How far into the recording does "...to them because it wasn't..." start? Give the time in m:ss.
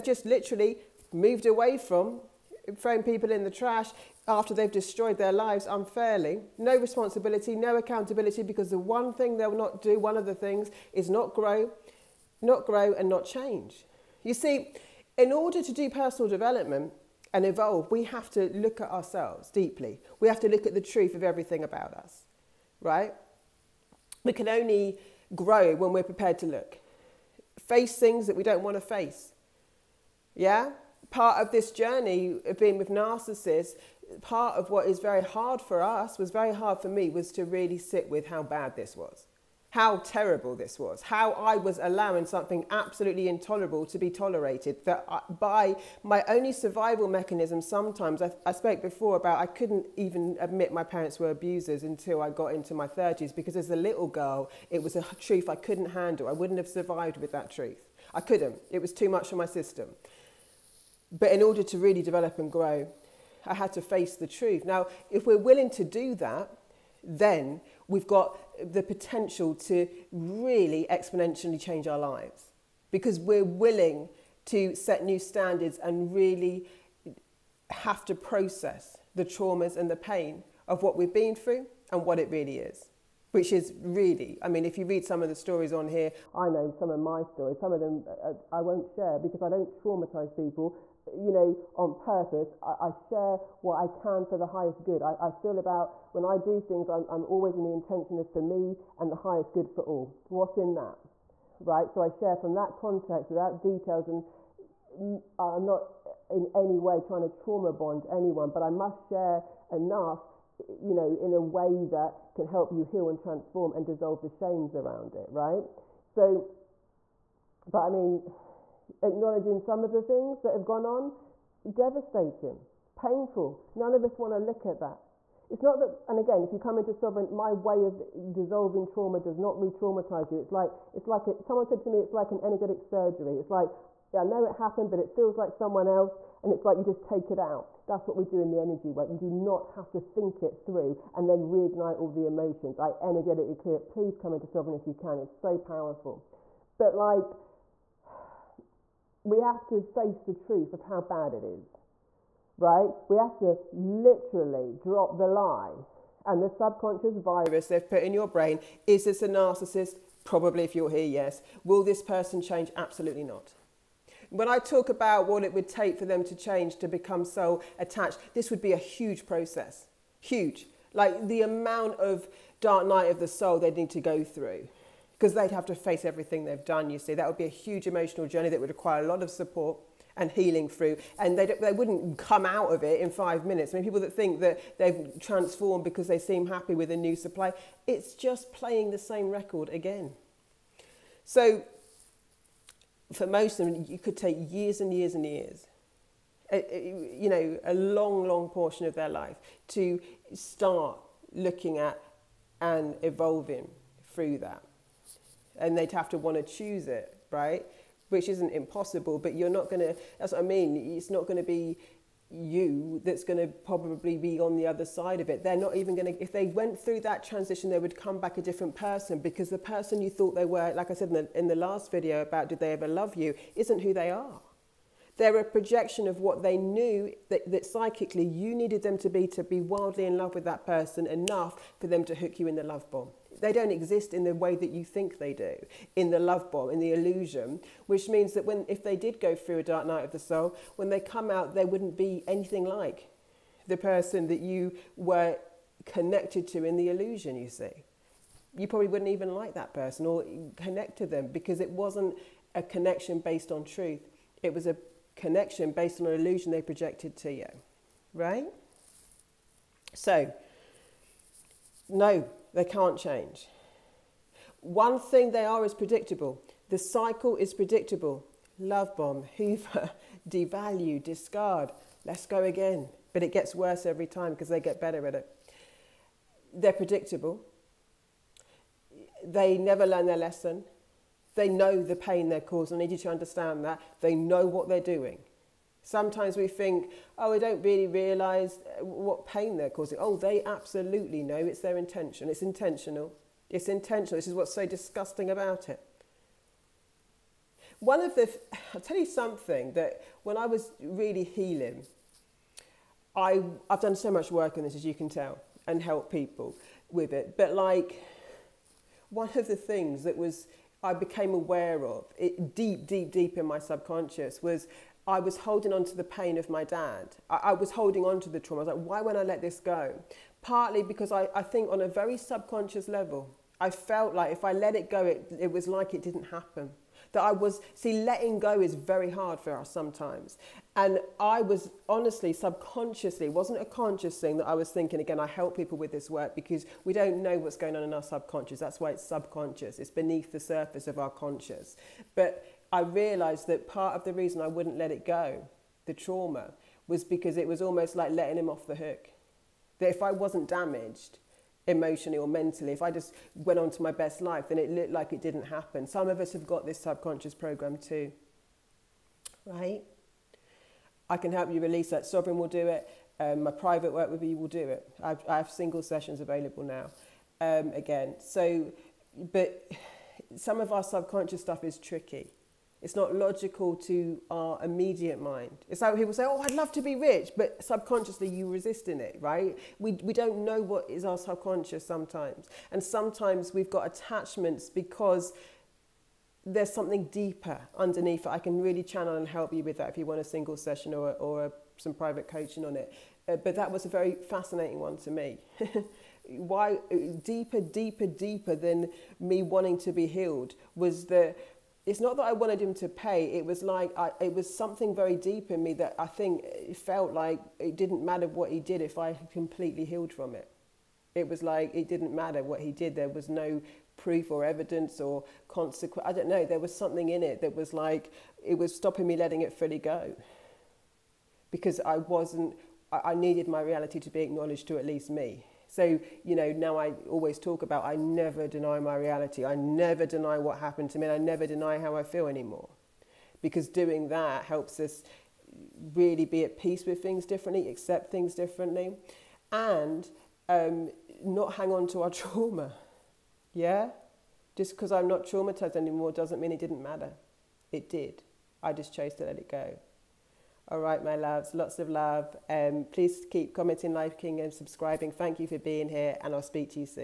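4:10.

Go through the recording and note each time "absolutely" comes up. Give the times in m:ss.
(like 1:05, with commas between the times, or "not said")
0:42, 2:42, 4:50.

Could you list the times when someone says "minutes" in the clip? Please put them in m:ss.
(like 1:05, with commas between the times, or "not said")
3:03.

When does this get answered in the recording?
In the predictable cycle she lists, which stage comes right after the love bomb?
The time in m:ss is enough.
4:29.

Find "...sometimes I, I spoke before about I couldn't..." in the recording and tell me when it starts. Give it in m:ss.
0:47.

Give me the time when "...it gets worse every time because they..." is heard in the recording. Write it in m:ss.
4:33.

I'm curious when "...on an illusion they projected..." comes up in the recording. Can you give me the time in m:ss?
4:15.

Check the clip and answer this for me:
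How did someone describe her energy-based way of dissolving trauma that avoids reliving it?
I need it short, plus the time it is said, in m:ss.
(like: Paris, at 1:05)
an energetic surgery, at 2:12.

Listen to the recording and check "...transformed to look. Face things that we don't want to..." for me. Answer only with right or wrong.
wrong.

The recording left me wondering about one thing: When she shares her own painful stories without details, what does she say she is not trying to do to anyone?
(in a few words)
trauma bond.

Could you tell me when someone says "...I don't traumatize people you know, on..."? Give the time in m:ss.
1:29.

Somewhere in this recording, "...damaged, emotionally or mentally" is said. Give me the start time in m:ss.
5:50.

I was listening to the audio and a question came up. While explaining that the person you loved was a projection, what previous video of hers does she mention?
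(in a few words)
Did they ever love you.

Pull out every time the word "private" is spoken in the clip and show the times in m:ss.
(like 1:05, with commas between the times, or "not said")
6:03, 6:31.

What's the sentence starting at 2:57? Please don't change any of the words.
That would be a huge emotional journey that would require a lot of support and healing through.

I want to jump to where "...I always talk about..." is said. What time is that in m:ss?
7:06.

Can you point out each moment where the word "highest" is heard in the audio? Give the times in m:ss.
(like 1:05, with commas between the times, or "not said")
1:34, 1:39.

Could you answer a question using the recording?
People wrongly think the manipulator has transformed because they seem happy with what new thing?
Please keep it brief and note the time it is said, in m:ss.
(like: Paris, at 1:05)
new supply, at 3:06.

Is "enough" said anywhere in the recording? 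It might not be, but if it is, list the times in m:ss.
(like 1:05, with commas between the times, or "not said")
1:49, 3:51.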